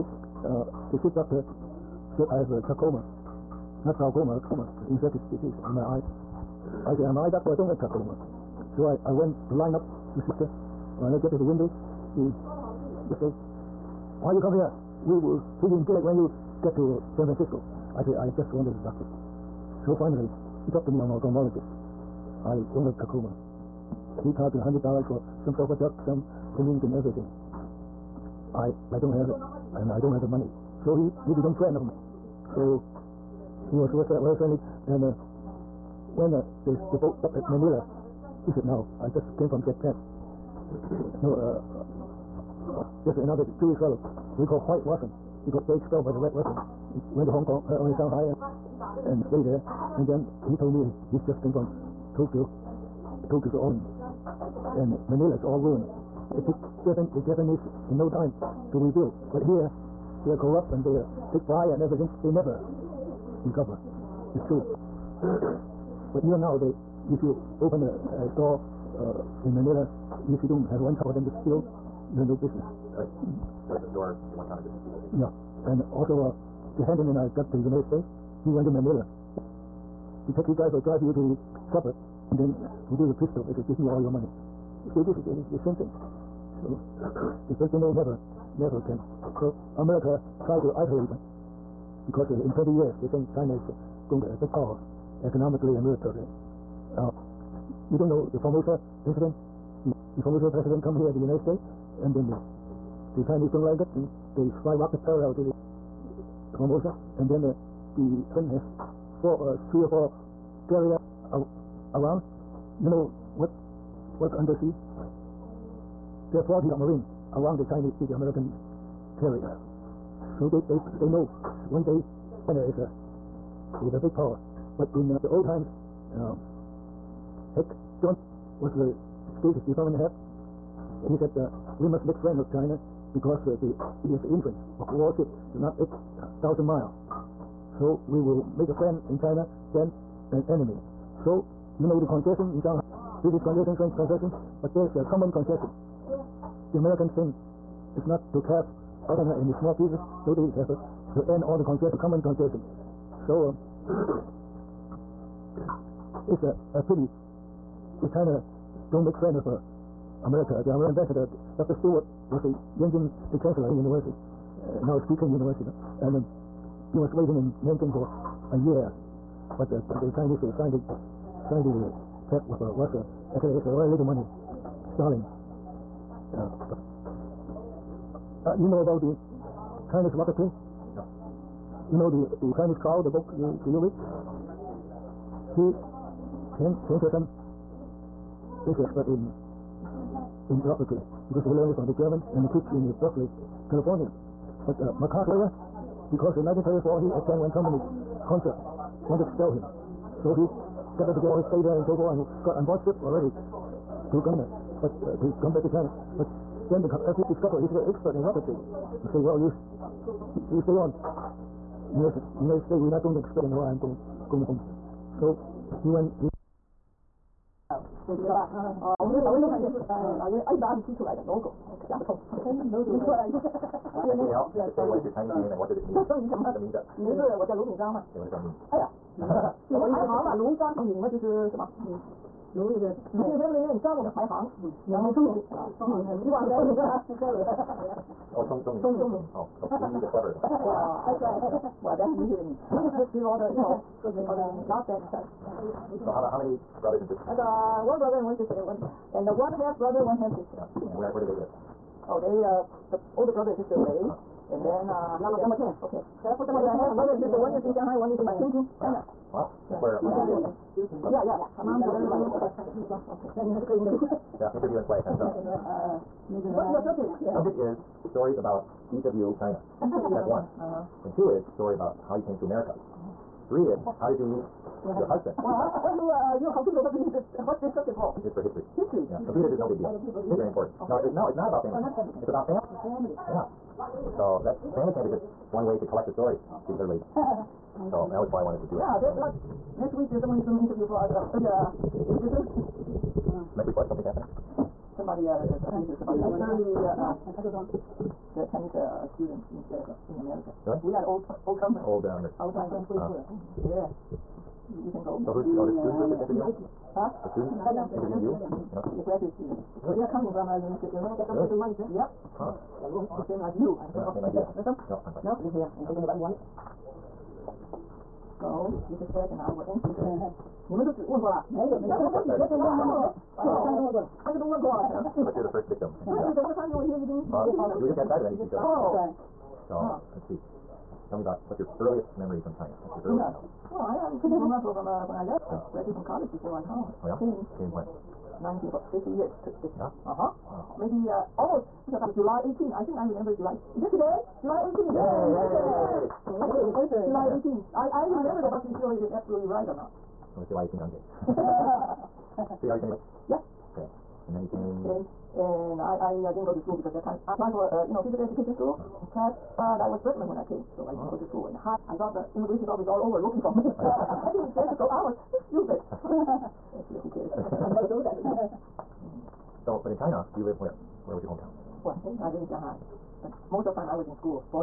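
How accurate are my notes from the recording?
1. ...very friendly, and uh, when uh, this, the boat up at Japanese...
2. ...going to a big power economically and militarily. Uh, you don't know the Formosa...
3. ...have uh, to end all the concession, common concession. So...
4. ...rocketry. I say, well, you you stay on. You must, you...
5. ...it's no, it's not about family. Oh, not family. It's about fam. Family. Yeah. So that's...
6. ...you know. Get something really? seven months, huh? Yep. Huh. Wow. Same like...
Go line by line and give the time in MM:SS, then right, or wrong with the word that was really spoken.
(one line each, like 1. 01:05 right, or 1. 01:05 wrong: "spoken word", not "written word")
1. 00:34 wrong: "Manila", not "Japanese"
2. 01:34 right
3. 02:30 right
4. 03:28 right
5. 04:41 right
6. 05:10 wrong: "two", not "seven".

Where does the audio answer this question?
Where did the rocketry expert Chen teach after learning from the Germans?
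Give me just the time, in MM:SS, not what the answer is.
03:13.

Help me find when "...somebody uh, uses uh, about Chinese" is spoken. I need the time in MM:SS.
04:54.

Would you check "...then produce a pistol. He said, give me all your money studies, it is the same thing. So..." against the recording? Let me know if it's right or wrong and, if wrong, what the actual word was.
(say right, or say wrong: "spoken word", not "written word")
right.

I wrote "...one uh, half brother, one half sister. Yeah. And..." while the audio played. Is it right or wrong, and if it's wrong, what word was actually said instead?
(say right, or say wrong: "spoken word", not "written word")
right.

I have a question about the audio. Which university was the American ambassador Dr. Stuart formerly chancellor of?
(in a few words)
Yanjing.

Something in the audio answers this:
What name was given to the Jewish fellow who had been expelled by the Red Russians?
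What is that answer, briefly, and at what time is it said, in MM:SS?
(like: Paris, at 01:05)
White Russian, at 00:44.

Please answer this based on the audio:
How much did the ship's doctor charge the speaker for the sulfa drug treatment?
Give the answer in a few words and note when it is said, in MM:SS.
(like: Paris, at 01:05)
$100, at 00:24.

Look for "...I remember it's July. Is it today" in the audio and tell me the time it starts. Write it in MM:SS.
05:42.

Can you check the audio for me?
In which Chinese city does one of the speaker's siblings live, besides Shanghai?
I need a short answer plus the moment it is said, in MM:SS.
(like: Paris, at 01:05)
Tianjin, at 04:18.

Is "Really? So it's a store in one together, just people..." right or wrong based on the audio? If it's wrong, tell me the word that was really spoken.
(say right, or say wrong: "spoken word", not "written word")
wrong: "counter", not "together".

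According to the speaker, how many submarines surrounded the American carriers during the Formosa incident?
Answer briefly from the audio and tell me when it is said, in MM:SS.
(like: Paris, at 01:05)
40, at 01:56.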